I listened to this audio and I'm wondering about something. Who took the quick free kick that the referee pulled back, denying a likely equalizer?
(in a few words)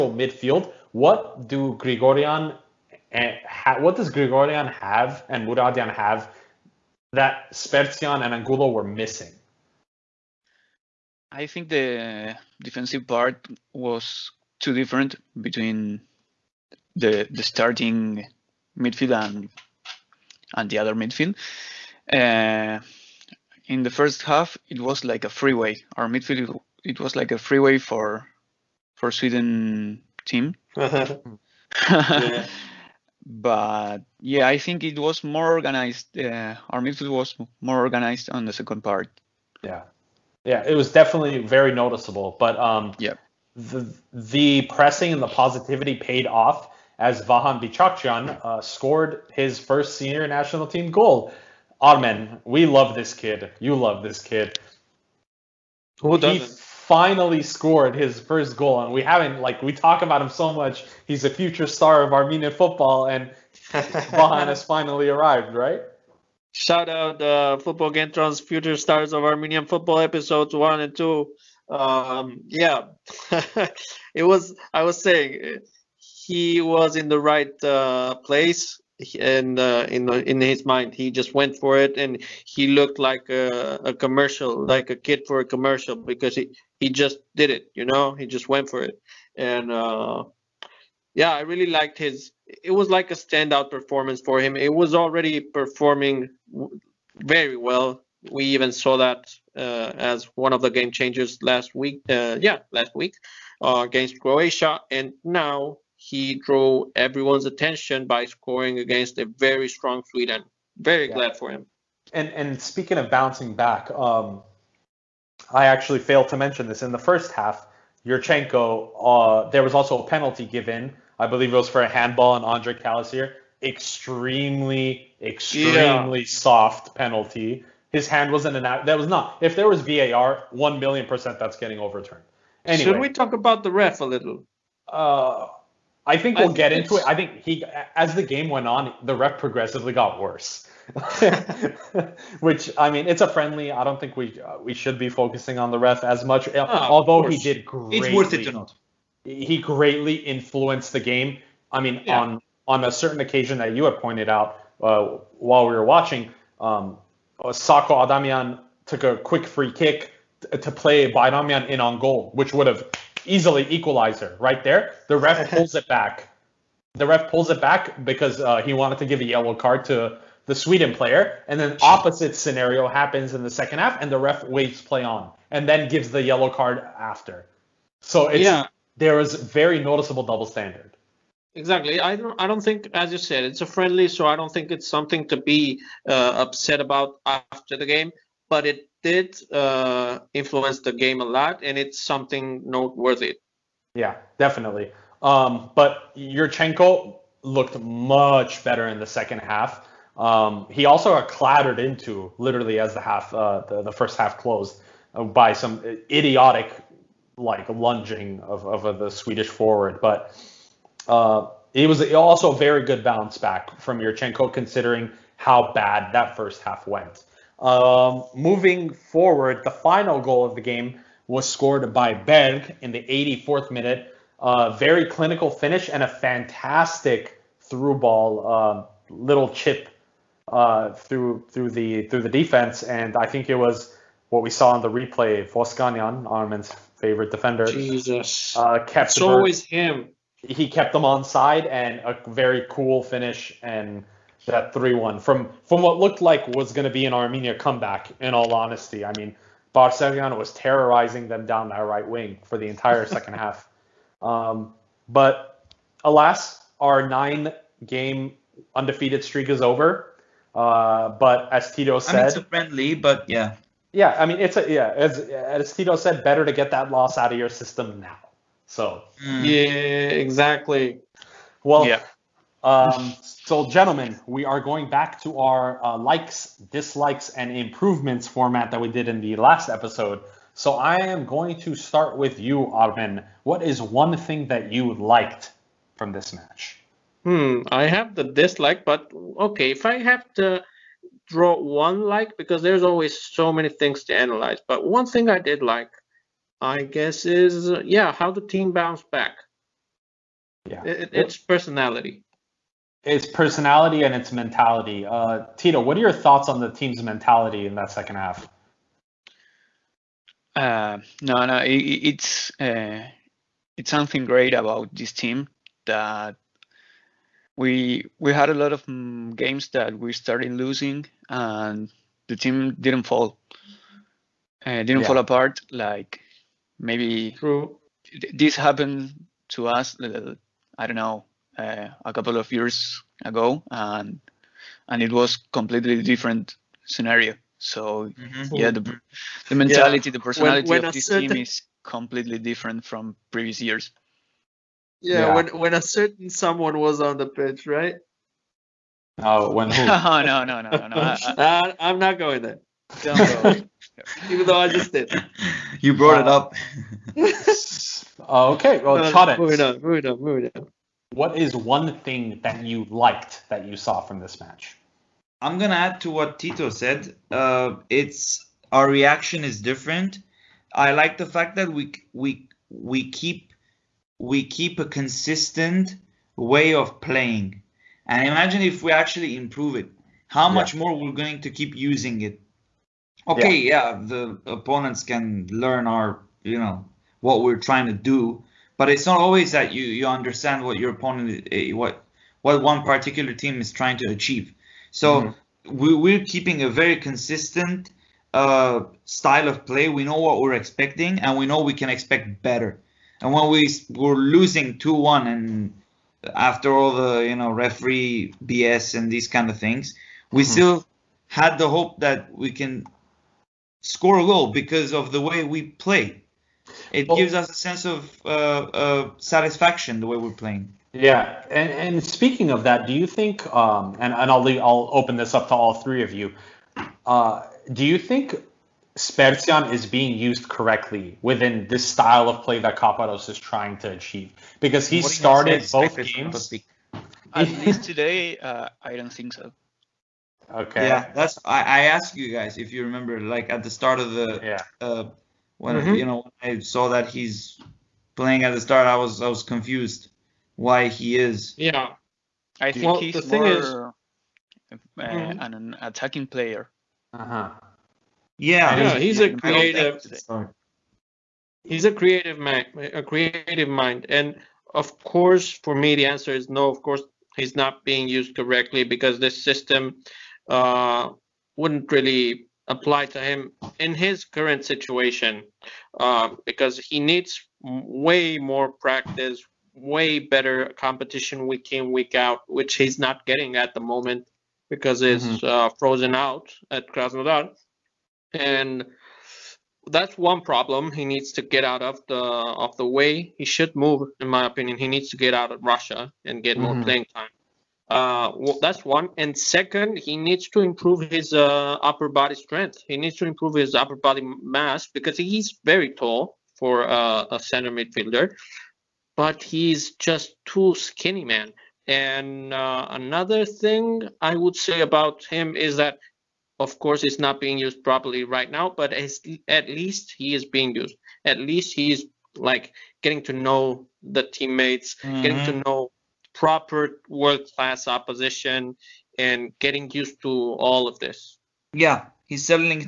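Sako Adamian.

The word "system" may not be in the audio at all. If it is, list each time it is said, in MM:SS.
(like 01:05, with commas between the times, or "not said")
04:27, 07:49.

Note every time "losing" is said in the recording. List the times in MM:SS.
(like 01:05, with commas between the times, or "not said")
05:20, 06:44.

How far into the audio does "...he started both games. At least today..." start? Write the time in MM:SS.
07:14.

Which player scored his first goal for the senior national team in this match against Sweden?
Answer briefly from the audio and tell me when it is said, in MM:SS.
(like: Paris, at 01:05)
Vahan Bichakhchyan, at 00:47.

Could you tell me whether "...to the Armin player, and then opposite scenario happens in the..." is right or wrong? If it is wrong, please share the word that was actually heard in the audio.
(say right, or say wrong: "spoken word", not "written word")
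wrong: "Sweden", not "Armin".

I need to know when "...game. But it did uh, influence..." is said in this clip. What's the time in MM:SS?
03:07.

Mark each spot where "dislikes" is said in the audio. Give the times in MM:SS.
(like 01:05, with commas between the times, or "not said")
04:36, 04:48.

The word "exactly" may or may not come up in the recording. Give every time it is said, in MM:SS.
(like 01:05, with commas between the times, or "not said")
03:01, 04:30.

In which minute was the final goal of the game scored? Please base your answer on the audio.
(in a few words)
84th.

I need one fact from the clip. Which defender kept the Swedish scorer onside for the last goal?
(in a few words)
Voskanyan.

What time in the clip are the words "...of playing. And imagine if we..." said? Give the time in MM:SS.
06:16.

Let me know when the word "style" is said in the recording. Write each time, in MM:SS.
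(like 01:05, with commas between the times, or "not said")
06:39, 07:11.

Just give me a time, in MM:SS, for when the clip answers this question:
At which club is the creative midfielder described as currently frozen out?
08:06.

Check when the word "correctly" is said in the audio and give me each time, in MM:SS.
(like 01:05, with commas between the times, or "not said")
07:10, 07:48.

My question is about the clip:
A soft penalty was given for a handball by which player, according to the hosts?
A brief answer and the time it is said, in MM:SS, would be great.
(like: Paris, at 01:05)
Andre Calisir, at 02:02.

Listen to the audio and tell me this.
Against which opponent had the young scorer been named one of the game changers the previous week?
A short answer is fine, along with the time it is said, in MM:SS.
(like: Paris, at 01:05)
Croatia, at 01:44.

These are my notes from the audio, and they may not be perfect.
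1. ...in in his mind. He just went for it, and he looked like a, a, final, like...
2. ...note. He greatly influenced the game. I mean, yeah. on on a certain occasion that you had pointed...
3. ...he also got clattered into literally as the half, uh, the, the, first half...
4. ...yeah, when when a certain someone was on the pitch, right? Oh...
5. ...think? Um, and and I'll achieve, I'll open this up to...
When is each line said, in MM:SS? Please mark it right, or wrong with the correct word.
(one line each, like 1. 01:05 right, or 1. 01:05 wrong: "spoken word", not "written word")
1. 01:19 wrong: "commercial", not "final"
2. 02:28 right
3. 03:20 right
4. 05:45 right
5. 07:03 wrong: "leave", not "achieve".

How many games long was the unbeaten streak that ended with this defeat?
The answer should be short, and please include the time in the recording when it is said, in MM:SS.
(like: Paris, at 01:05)
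9, at 04:17.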